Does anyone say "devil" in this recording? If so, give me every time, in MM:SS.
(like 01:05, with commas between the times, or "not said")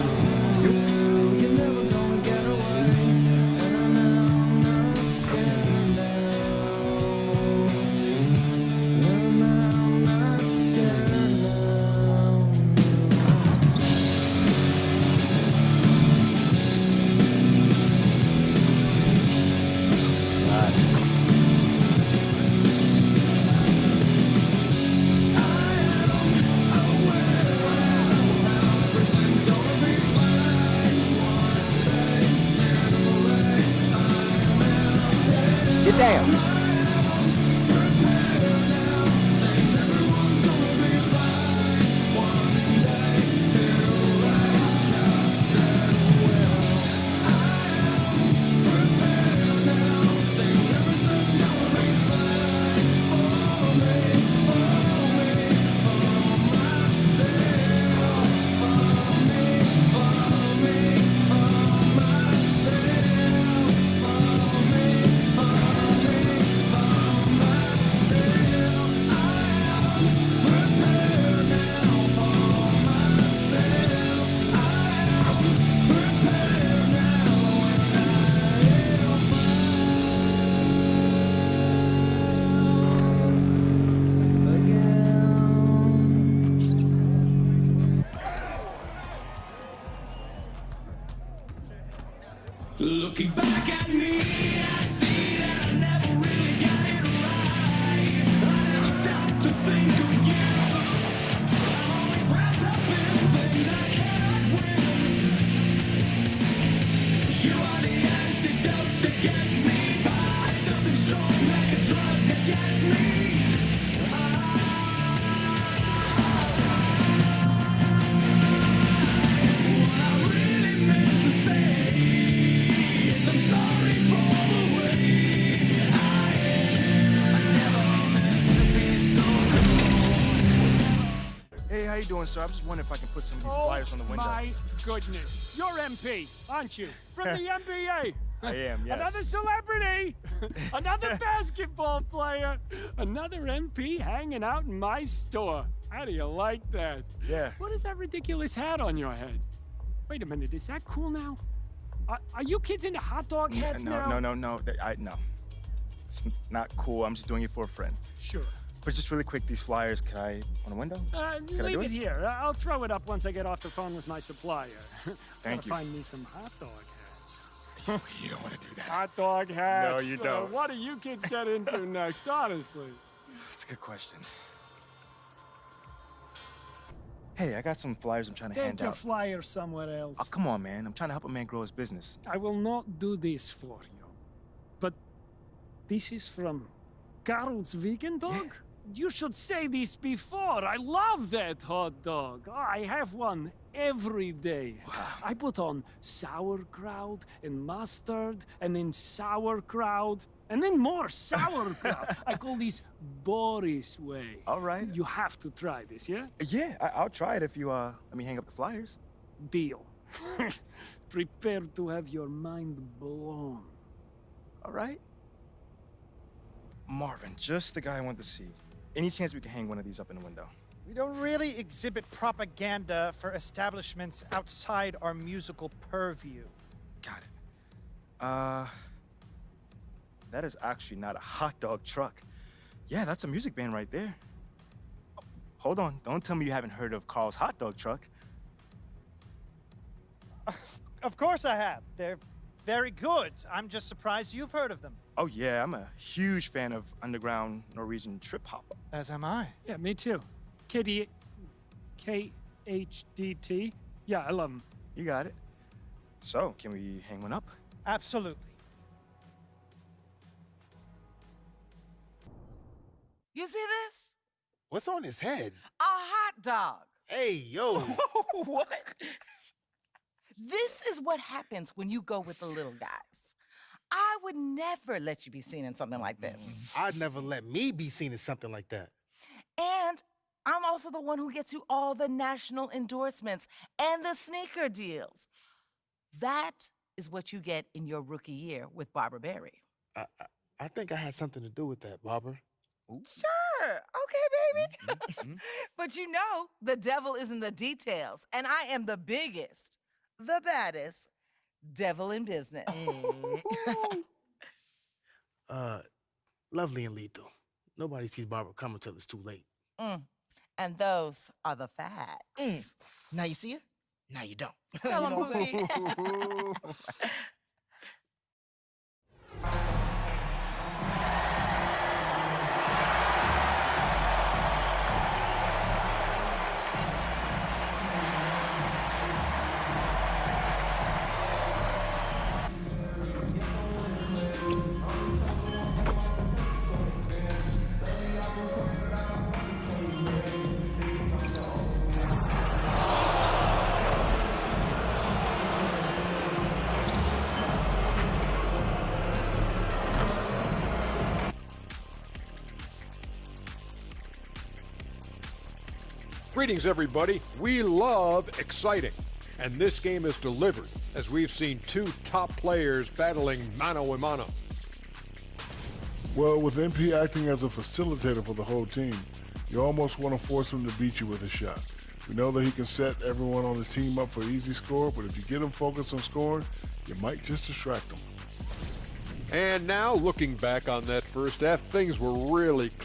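04:56, 05:01.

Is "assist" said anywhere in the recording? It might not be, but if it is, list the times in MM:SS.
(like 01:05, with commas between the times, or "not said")
not said.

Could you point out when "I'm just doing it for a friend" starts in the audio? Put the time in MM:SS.
02:37.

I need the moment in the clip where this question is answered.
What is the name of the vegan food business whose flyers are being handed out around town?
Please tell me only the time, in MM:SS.
03:07.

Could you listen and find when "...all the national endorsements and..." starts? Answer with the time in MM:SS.
04:41.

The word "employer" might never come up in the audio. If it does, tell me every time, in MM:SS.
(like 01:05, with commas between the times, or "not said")
not said.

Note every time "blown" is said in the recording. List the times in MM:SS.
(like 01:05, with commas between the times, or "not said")
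03:33.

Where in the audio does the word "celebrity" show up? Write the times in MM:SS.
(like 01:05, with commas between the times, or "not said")
02:19.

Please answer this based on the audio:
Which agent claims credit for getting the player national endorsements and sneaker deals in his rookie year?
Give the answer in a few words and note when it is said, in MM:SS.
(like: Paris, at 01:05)
Barbara Berry, at 04:48.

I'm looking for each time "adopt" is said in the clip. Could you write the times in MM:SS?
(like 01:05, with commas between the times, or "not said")
not said.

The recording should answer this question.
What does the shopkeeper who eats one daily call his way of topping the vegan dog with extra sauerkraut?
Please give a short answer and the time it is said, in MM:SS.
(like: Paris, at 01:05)
Boris way, at 03:23.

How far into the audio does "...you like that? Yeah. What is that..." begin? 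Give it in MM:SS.
02:26.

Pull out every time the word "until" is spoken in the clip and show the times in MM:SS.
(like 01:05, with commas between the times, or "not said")
05:08.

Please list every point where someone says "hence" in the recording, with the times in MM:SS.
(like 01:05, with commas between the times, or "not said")
not said.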